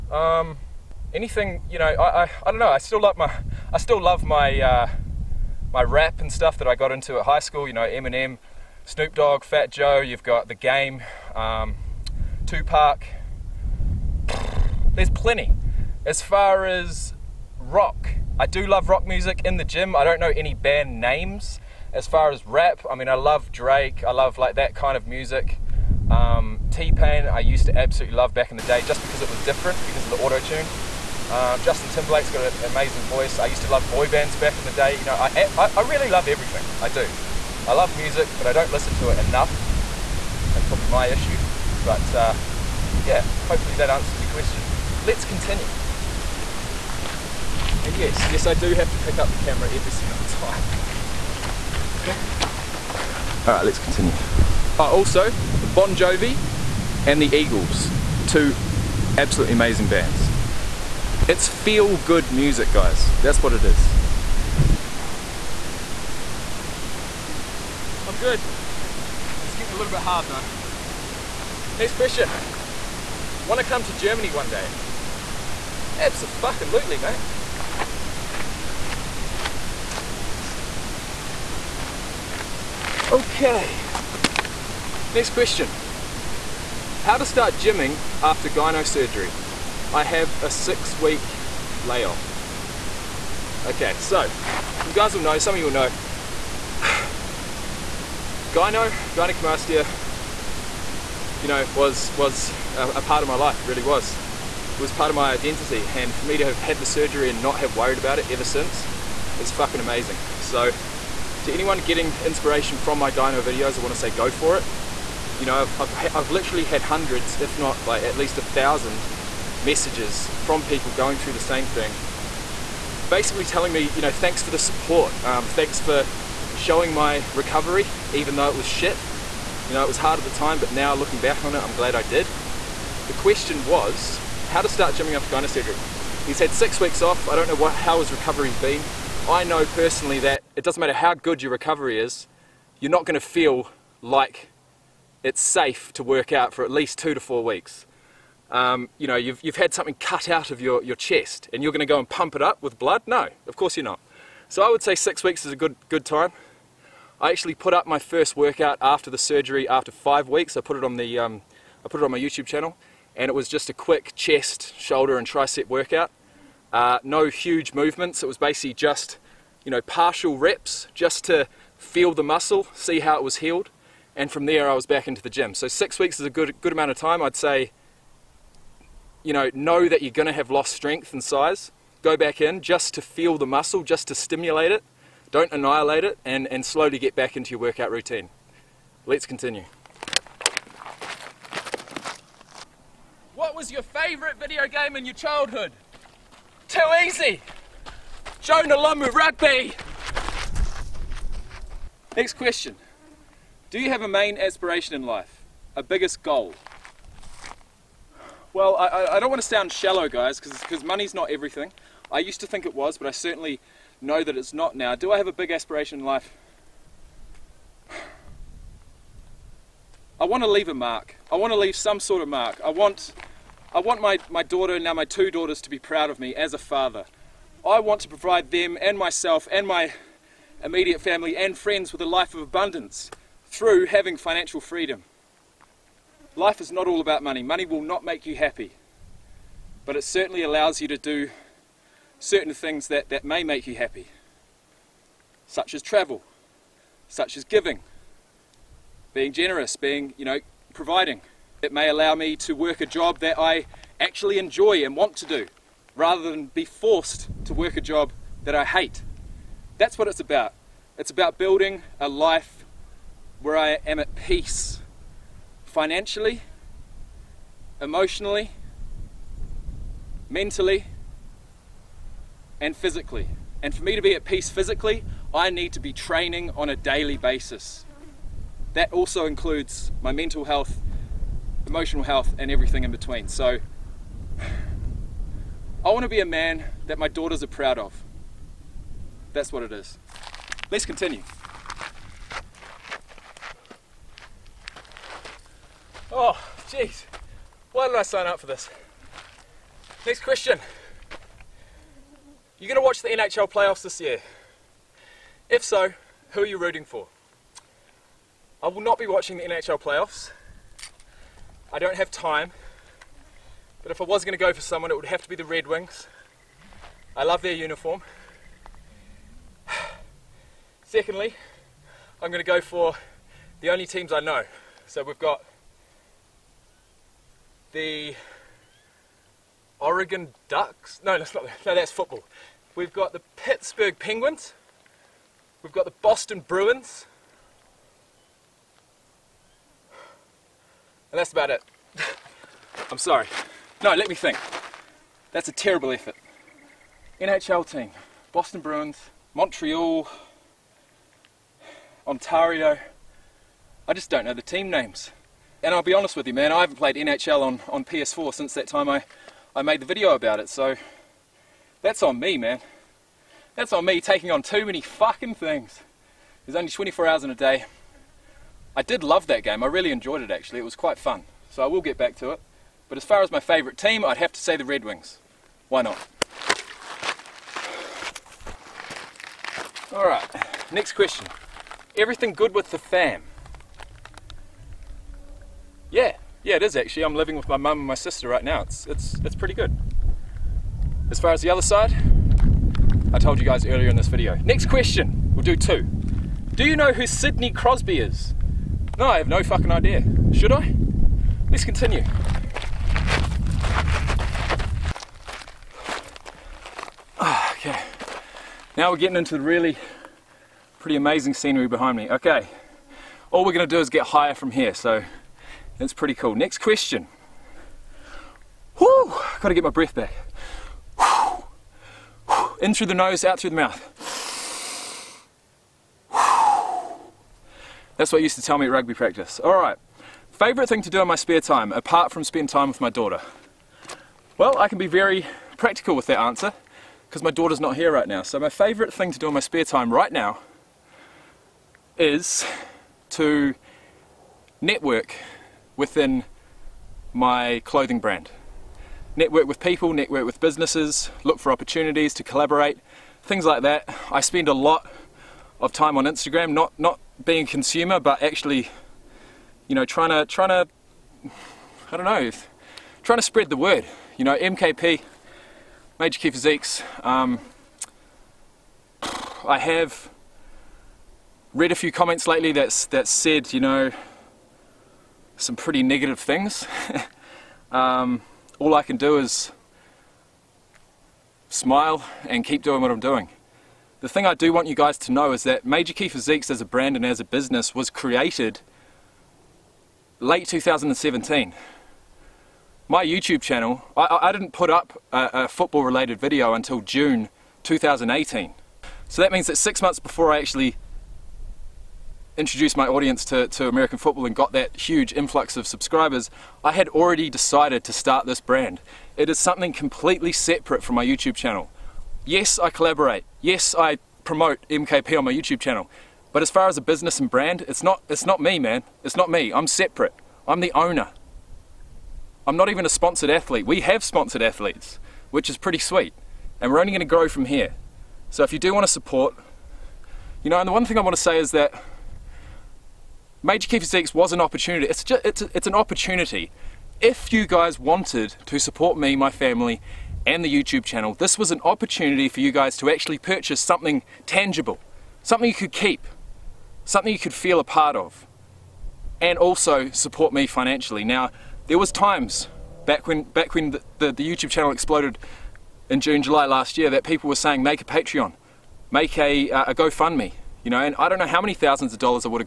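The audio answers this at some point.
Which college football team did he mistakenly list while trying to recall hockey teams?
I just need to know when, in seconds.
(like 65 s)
329 s.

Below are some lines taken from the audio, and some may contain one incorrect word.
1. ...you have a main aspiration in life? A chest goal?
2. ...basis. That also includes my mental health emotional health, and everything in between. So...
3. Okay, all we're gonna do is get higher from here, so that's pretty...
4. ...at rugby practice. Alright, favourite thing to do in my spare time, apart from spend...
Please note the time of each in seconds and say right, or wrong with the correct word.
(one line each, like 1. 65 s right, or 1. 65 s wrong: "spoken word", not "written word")
1. 203 s wrong: "biggest", not "chest"
2. 277 s right
3. 412 s right
4. 428 s right.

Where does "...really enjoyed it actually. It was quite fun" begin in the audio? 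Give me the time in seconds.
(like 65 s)
369 s.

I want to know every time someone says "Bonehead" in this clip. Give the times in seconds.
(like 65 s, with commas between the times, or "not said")
not said.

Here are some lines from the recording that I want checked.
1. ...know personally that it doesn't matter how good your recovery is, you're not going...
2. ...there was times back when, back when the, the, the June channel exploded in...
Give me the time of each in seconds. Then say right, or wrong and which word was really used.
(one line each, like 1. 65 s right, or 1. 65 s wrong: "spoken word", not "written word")
1. 139 s right
2. 551 s wrong: "YouTube", not "June".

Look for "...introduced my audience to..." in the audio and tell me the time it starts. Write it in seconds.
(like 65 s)
502 s.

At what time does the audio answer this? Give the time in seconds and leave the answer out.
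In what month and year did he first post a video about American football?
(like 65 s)
496 s.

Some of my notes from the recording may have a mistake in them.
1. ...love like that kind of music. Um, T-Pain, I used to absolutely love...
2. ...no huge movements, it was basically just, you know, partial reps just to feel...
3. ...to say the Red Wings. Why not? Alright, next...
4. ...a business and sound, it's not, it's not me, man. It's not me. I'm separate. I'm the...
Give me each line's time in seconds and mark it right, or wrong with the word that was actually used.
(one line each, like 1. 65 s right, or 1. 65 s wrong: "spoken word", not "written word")
1. 24 s right
2. 167 s right
3. 374 s right
4. 516 s wrong: "brand", not "sound".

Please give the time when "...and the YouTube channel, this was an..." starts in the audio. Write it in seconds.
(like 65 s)
540 s.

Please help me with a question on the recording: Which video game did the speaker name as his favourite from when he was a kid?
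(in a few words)
Jonah Lomu Rugby.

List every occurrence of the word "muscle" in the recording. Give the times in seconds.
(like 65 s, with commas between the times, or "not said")
172 s, 183 s.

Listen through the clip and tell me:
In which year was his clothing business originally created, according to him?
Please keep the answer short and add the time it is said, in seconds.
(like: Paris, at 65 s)
2017, at 490 s.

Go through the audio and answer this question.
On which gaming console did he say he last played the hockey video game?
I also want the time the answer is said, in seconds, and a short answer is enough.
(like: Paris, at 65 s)
PS4, at 357 s.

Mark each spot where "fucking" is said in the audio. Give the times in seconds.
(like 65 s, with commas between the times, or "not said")
109 s, 364 s, 399 s.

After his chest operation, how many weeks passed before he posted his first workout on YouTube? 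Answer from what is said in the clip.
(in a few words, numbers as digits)
5.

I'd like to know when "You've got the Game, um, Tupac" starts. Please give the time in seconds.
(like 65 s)
9 s.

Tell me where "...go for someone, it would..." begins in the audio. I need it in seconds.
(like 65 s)
314 s.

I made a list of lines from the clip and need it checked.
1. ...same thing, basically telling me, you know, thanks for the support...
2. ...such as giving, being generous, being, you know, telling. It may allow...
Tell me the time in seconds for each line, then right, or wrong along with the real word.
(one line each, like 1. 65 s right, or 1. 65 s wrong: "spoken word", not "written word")
1. 121 s right
2. 247 s wrong: "providing", not "telling".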